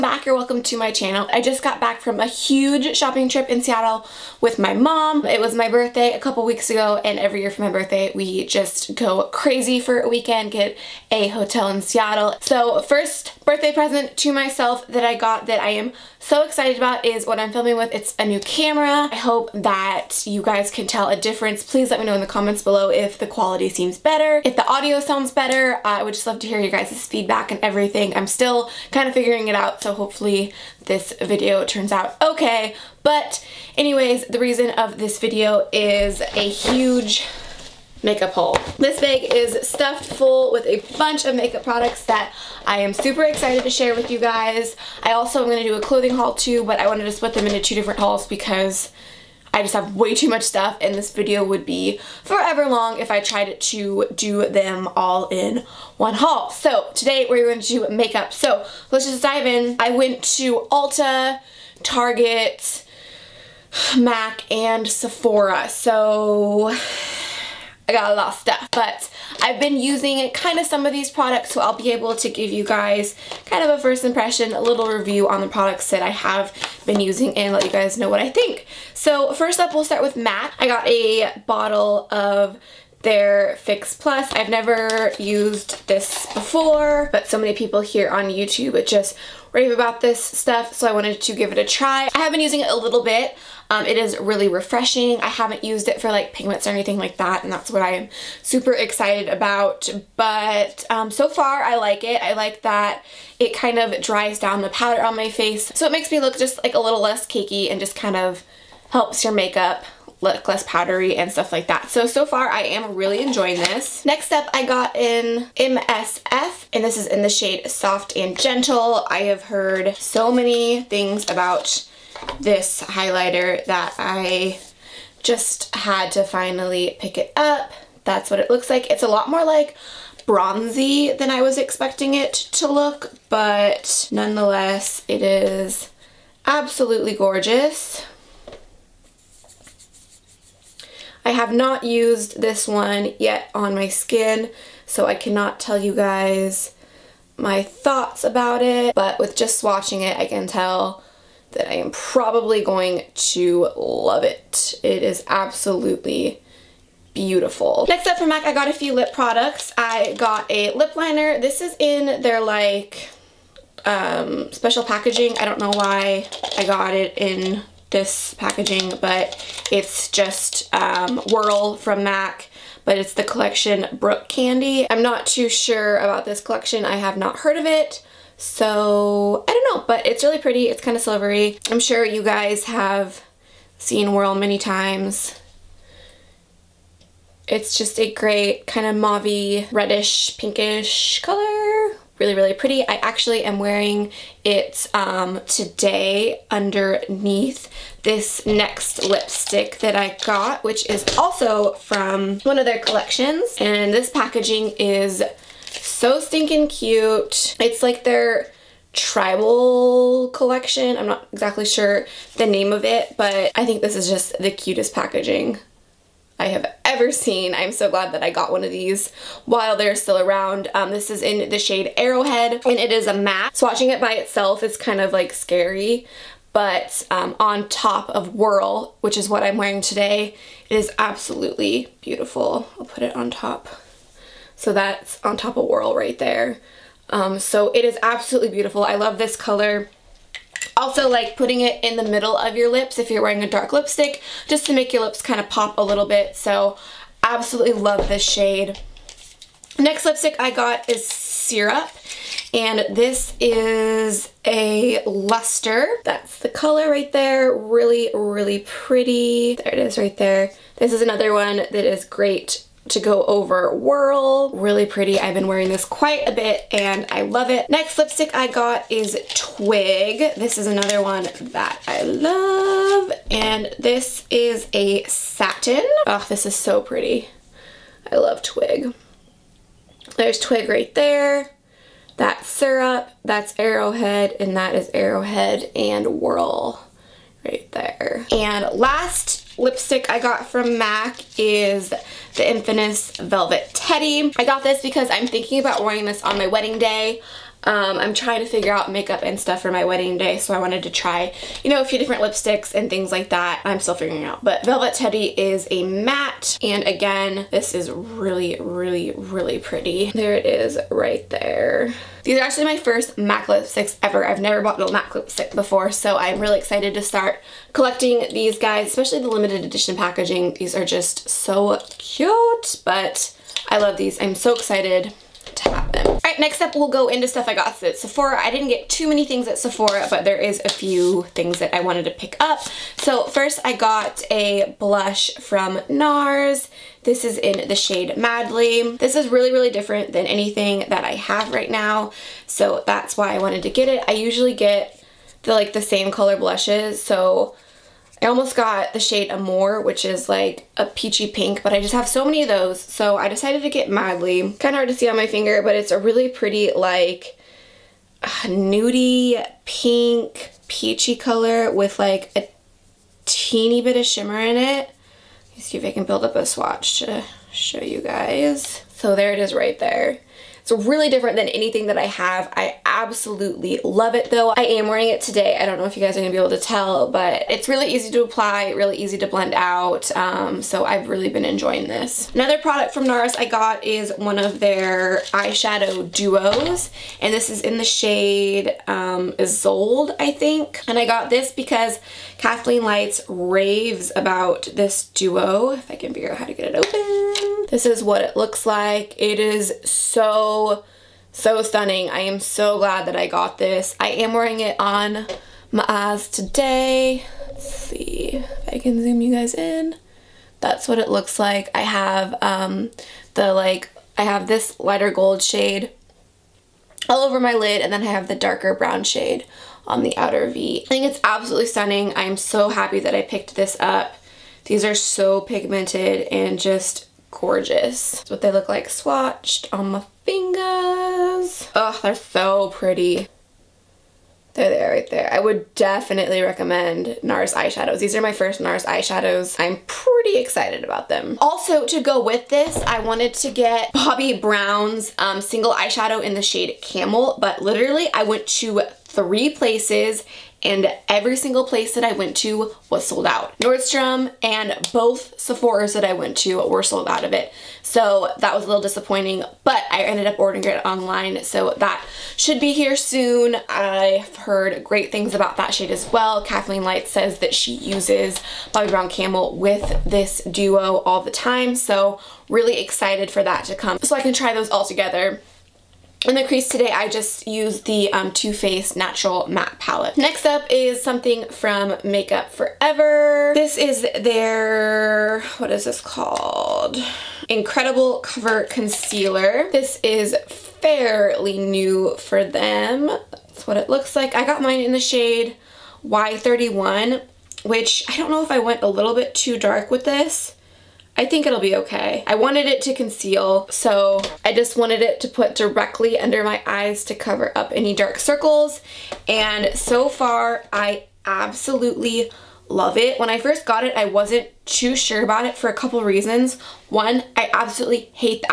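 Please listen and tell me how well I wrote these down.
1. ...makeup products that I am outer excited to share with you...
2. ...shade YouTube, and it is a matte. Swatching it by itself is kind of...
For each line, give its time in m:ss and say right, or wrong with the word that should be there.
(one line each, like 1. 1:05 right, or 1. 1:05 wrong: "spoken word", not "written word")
1. 0:41 wrong: "super", not "outer"
2. 3:41 wrong: "Arrowhead", not "YouTube".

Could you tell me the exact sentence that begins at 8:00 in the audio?
Next up is something from Makeup Forever.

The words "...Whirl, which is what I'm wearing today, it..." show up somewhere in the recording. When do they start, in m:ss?
3:48.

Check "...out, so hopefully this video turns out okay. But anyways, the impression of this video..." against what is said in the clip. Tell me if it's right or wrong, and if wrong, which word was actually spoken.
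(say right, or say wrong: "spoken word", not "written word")
wrong: "reason", not "impression".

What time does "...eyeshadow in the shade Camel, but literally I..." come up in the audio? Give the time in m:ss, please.
7:25.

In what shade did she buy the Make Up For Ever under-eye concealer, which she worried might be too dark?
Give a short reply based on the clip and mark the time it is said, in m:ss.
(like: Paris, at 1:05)
Y31, at 8:16.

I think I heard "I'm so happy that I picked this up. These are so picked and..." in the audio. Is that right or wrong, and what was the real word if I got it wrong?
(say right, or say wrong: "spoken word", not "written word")
wrong: "pigmented", not "picked".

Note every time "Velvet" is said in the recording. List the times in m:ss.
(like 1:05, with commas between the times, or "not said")
4:53, 5:04.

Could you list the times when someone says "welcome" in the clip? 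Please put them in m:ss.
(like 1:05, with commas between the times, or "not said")
0:00.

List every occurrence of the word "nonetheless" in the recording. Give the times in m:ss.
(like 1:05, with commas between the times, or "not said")
2:14.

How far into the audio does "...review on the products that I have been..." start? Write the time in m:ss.
1:14.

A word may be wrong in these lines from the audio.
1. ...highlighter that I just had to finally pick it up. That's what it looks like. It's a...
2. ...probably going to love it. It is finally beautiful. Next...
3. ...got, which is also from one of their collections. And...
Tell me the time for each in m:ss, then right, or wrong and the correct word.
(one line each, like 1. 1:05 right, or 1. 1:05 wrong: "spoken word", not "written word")
1. 2:02 right
2. 2:31 wrong: "absolutely", not "finally"
3. 3:20 right.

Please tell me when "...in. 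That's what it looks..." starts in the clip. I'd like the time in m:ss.
6:49.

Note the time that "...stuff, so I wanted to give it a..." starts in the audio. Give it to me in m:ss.
1:30.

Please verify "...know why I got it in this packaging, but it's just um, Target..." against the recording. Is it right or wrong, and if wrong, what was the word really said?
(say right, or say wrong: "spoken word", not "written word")
wrong: "Whirl", not "Target".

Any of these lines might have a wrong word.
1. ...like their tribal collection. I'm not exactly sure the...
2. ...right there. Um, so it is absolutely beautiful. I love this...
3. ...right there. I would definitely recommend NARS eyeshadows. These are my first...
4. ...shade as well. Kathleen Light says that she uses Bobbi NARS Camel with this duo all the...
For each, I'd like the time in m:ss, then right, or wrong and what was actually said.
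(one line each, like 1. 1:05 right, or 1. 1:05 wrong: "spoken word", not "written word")
1. 3:27 right
2. 3:55 right
3. 7:14 right
4. 7:45 wrong: "Brown", not "NARS".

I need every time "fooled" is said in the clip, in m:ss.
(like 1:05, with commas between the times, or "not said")
not said.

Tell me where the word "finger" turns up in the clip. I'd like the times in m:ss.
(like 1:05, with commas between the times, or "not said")
5:55, 7:10.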